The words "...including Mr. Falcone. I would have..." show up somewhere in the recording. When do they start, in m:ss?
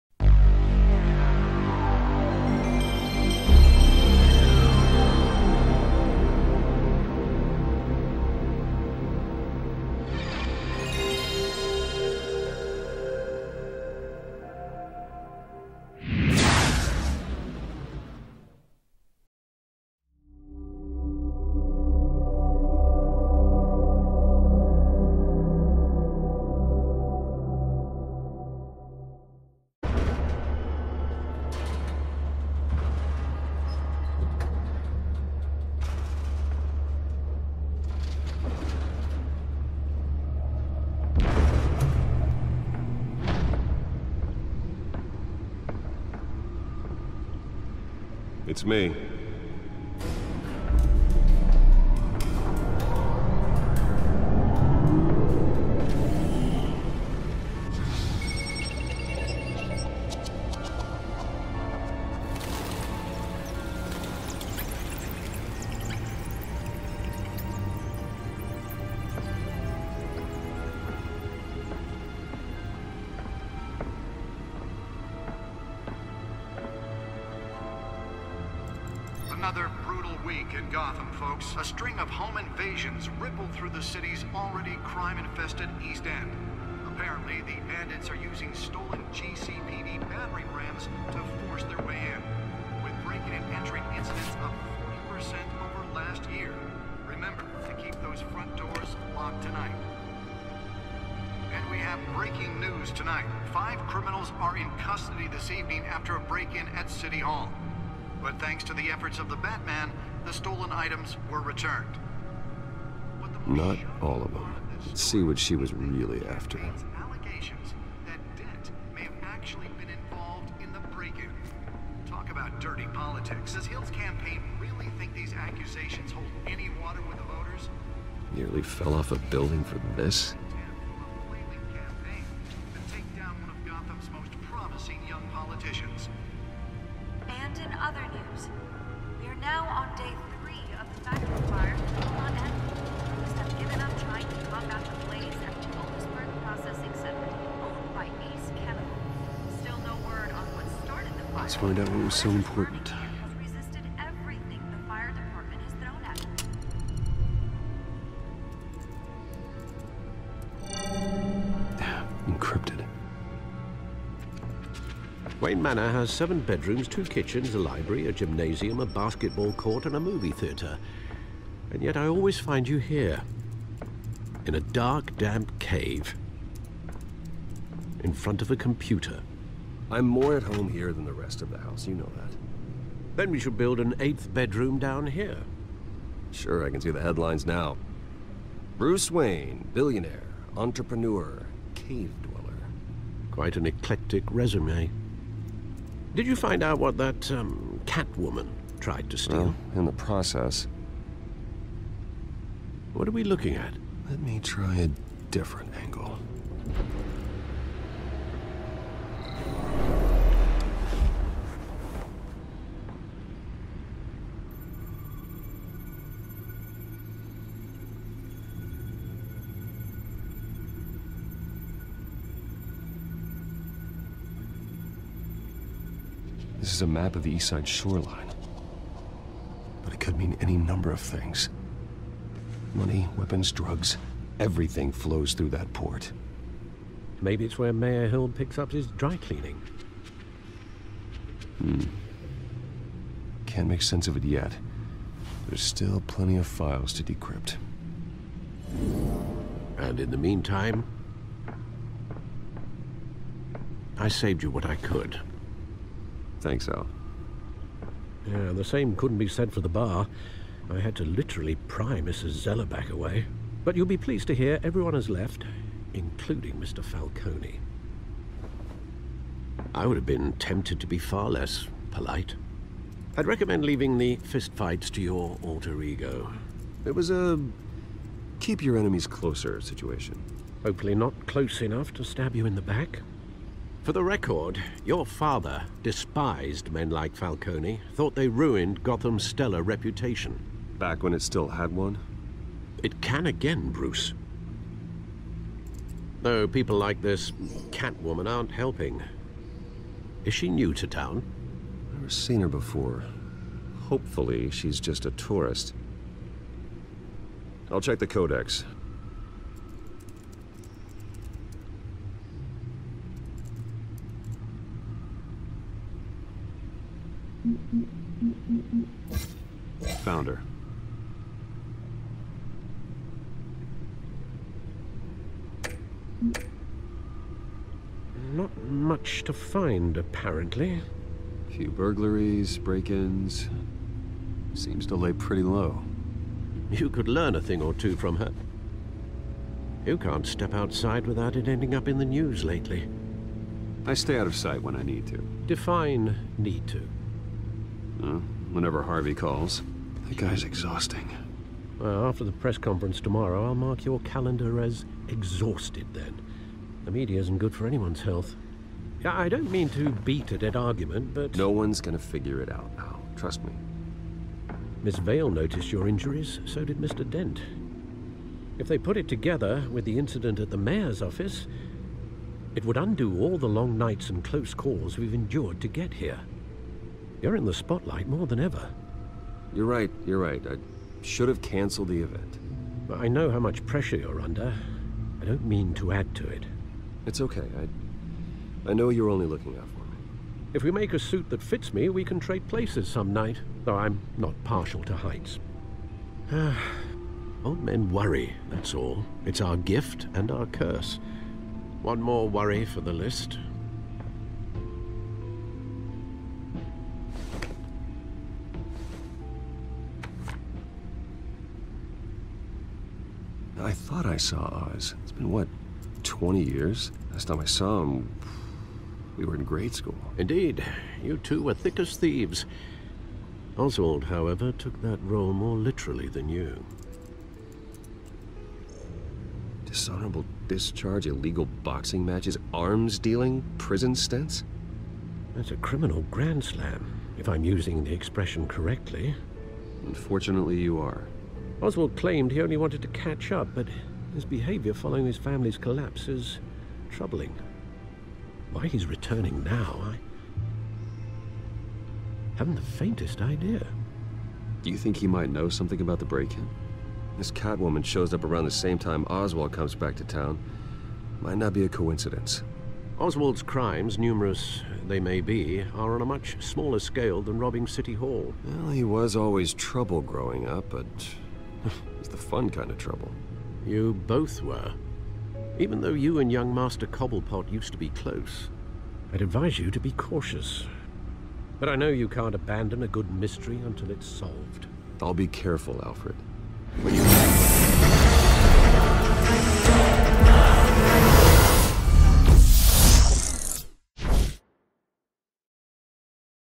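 4:25.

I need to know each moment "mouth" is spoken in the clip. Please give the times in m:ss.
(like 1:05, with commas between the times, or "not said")
not said.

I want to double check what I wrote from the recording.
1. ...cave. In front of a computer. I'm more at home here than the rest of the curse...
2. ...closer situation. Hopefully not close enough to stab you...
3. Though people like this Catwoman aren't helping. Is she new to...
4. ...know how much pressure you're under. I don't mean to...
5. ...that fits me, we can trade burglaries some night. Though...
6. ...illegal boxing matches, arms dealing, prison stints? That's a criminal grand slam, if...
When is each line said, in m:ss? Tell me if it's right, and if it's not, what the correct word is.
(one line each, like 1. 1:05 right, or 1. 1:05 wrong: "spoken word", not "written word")
1. 2:55 wrong: "house", not "curse"
2. 4:39 right
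3. 4:56 right
4. 6:23 right
5. 6:31 wrong: "places", not "burglaries"
6. 7:11 right.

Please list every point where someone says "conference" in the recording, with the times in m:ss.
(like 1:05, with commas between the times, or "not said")
5:52.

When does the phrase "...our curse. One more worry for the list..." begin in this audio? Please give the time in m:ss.
6:40.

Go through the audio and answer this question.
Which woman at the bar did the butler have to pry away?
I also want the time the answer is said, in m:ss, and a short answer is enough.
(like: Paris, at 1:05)
Mrs. Zeller, at 4:22.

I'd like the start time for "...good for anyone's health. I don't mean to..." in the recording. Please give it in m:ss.
5:57.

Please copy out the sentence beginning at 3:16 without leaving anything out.
Did you find out what that um, Catwoman tried to steal?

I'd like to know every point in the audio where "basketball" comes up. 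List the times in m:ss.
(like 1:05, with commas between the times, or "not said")
2:48.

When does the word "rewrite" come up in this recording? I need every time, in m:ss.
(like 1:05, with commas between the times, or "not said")
not said.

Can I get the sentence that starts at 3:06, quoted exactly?
Sure, I can see the headlines now.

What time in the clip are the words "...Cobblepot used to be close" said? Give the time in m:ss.
7:56.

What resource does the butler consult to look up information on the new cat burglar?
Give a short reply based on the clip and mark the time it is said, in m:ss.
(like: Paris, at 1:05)
the codex, at 5:08.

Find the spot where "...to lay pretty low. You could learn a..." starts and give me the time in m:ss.
5:34.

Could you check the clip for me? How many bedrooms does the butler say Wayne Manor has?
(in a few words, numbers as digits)
7.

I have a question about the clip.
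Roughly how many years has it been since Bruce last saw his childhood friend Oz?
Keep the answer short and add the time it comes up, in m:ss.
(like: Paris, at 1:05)
20, at 6:56.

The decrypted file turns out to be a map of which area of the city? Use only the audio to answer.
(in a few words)
east side shoreline.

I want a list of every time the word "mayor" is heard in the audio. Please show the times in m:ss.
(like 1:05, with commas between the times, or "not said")
3:57, 6:10.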